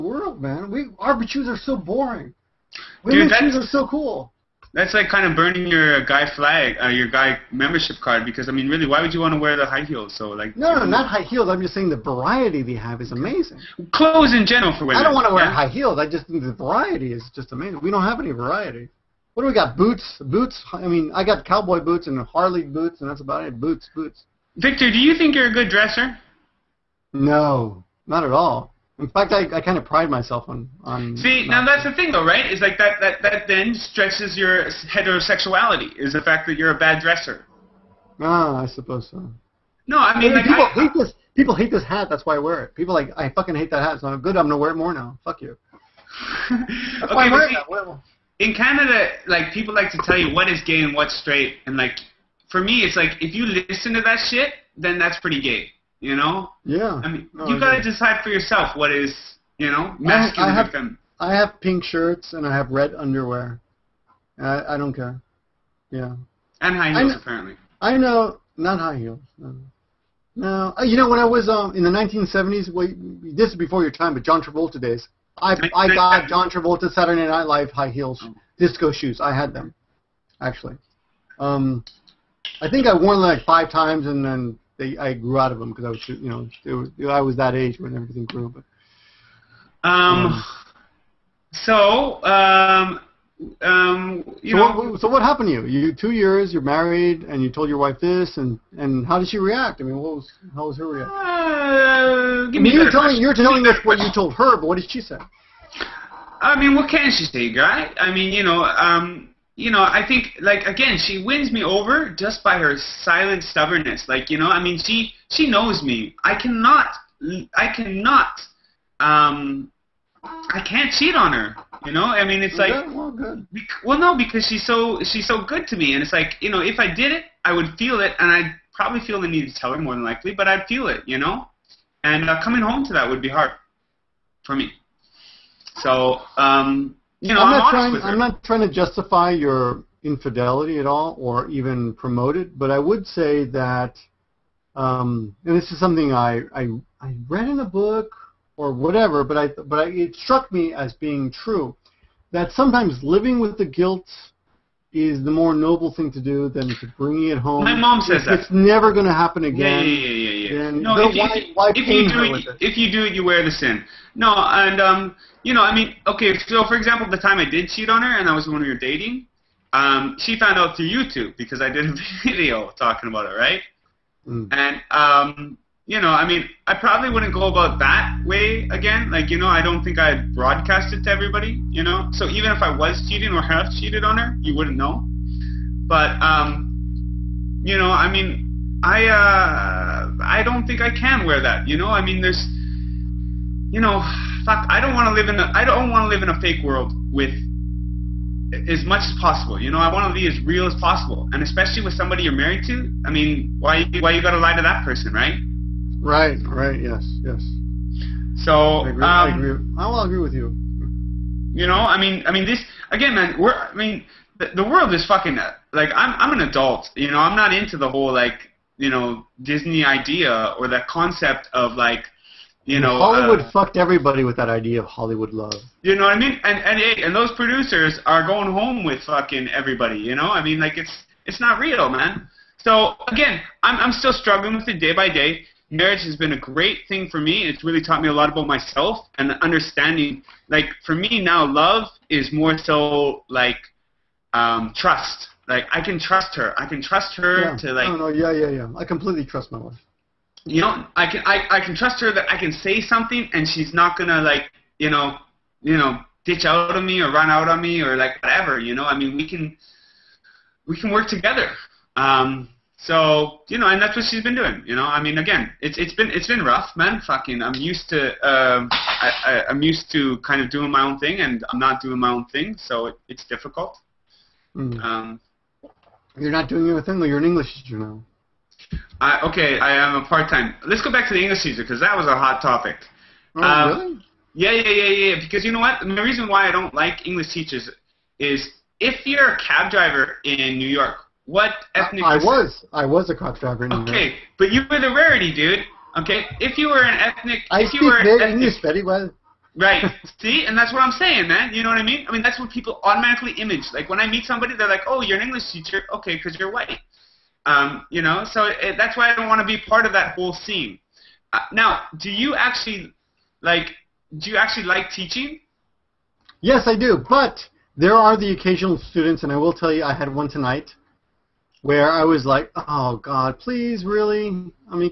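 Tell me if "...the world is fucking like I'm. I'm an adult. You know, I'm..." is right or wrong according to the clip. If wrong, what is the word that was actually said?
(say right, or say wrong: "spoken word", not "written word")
right.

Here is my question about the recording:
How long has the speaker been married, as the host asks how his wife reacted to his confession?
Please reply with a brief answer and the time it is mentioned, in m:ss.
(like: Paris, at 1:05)
2 years, at 1:35.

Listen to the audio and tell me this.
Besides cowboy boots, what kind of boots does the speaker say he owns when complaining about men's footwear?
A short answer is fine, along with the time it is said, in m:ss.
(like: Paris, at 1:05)
Harley boots, at 0:22.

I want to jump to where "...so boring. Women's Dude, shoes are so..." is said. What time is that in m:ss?
0:01.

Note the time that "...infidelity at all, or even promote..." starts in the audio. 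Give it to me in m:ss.
2:20.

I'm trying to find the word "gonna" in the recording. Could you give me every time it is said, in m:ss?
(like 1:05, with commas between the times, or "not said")
0:44, 4:13.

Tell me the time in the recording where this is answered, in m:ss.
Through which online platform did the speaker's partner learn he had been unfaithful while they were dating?
2:50.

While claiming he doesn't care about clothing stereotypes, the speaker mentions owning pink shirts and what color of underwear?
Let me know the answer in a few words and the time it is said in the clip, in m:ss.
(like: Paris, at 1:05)
Red, at 1:02.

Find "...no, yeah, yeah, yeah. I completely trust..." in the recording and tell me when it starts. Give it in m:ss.
4:07.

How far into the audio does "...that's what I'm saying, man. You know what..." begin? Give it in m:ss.
5:00.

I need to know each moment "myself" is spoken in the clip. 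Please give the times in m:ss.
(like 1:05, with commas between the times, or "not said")
0:30, 3:58.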